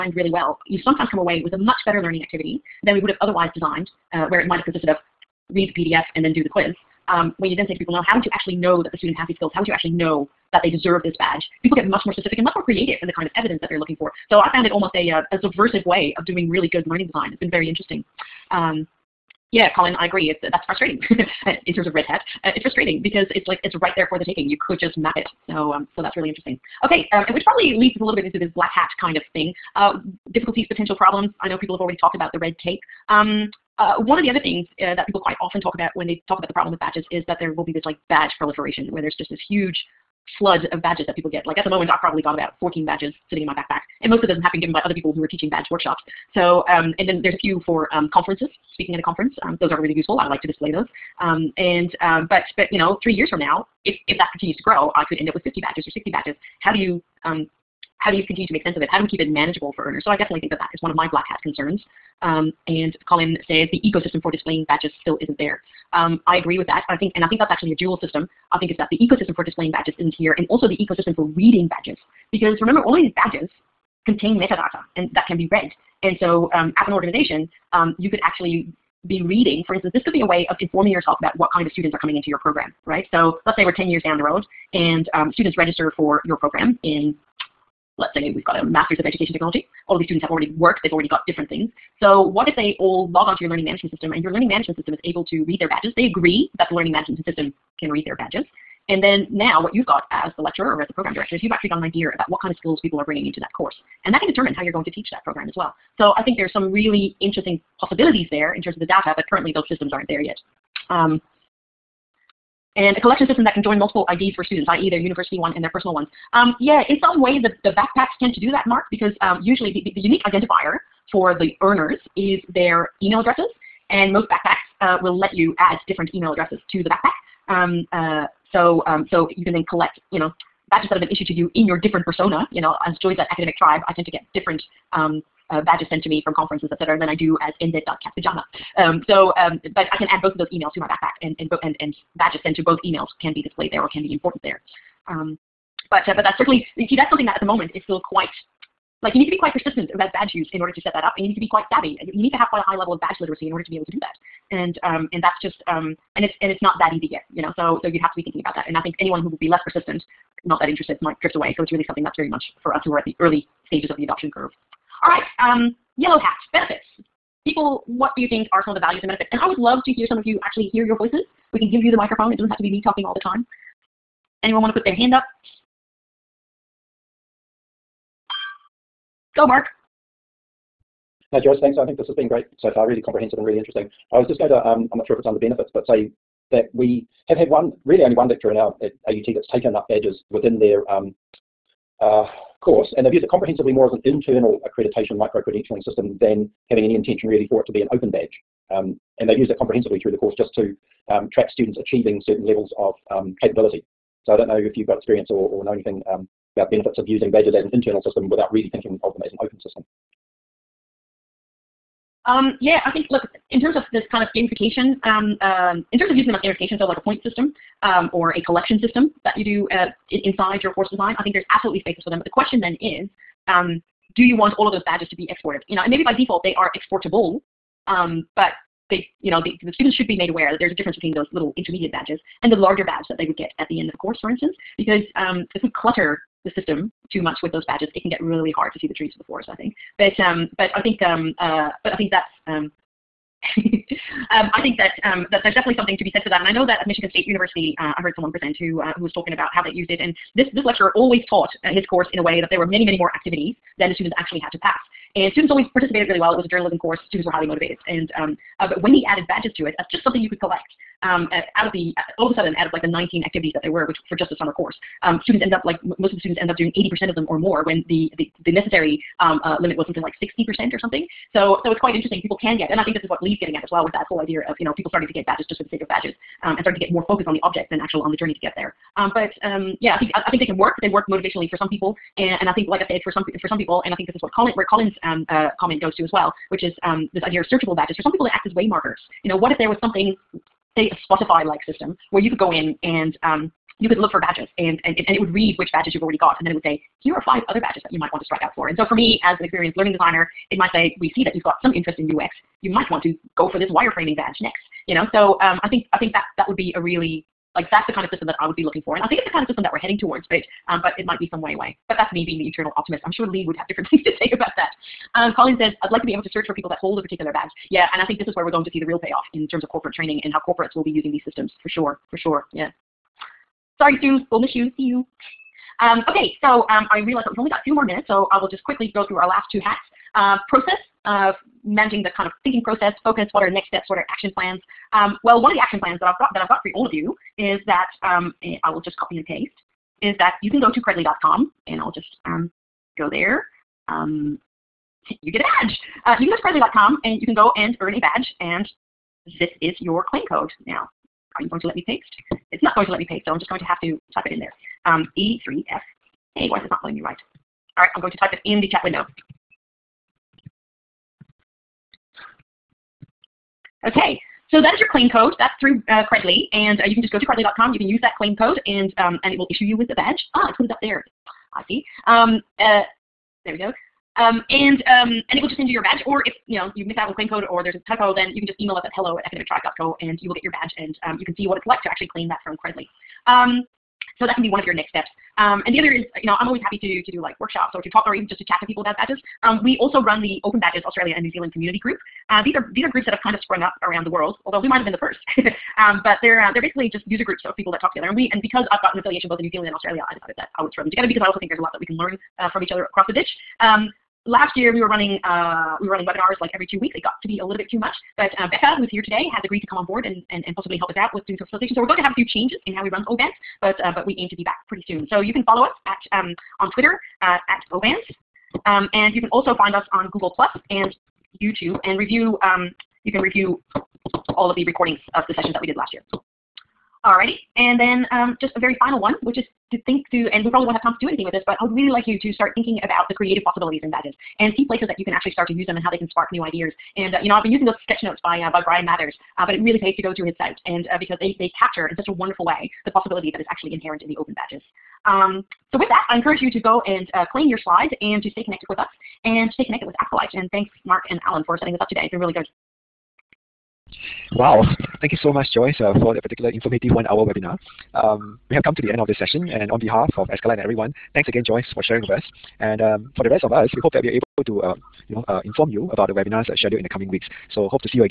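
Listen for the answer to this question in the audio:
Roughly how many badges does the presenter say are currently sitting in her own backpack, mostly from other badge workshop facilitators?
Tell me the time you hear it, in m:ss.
0:42.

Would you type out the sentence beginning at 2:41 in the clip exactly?
So it's really something that's very much for us who are at the early stages of the adoption curve.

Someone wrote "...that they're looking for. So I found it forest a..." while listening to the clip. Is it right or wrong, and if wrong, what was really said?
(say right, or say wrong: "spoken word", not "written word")
wrong: "almost", not "forest".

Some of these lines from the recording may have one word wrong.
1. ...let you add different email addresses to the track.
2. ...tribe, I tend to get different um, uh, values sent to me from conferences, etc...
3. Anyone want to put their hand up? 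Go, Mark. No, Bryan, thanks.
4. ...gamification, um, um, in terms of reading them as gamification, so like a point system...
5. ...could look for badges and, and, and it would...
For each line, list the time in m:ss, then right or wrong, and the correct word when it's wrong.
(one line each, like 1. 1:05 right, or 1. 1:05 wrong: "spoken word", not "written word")
1. 2:05 wrong: "backpack", not "track"
2. 2:13 wrong: "badges", not "values"
3. 2:54 wrong: "Joyce", not "Bryan"
4. 3:34 wrong: "using", not "reading"
5. 4:53 right.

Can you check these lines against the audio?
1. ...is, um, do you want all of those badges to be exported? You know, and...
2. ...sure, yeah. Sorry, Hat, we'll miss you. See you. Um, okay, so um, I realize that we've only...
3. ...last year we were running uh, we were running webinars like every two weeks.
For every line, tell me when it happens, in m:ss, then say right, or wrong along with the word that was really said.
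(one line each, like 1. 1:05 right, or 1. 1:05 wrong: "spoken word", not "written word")
1. 3:42 right
2. 5:22 wrong: "Sue", not "Hat"
3. 6:44 right.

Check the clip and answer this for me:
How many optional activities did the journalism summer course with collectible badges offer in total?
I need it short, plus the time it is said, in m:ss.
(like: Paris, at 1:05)
19, at 4:22.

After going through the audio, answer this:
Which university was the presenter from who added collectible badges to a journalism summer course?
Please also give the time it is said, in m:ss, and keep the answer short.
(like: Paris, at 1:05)
Michigan State University, at 4:06.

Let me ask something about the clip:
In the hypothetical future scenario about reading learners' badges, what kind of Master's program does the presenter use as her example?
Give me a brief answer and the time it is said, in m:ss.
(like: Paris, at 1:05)
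Master's of Education Technology, at 1:28.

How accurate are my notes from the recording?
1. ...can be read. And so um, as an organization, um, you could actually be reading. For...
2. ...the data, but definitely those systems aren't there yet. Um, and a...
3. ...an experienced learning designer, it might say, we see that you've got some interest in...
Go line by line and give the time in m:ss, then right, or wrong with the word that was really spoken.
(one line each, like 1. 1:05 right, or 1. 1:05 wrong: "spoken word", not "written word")
1. 1:15 right
2. 1:48 wrong: "currently", not "definitely"
3. 4:59 right.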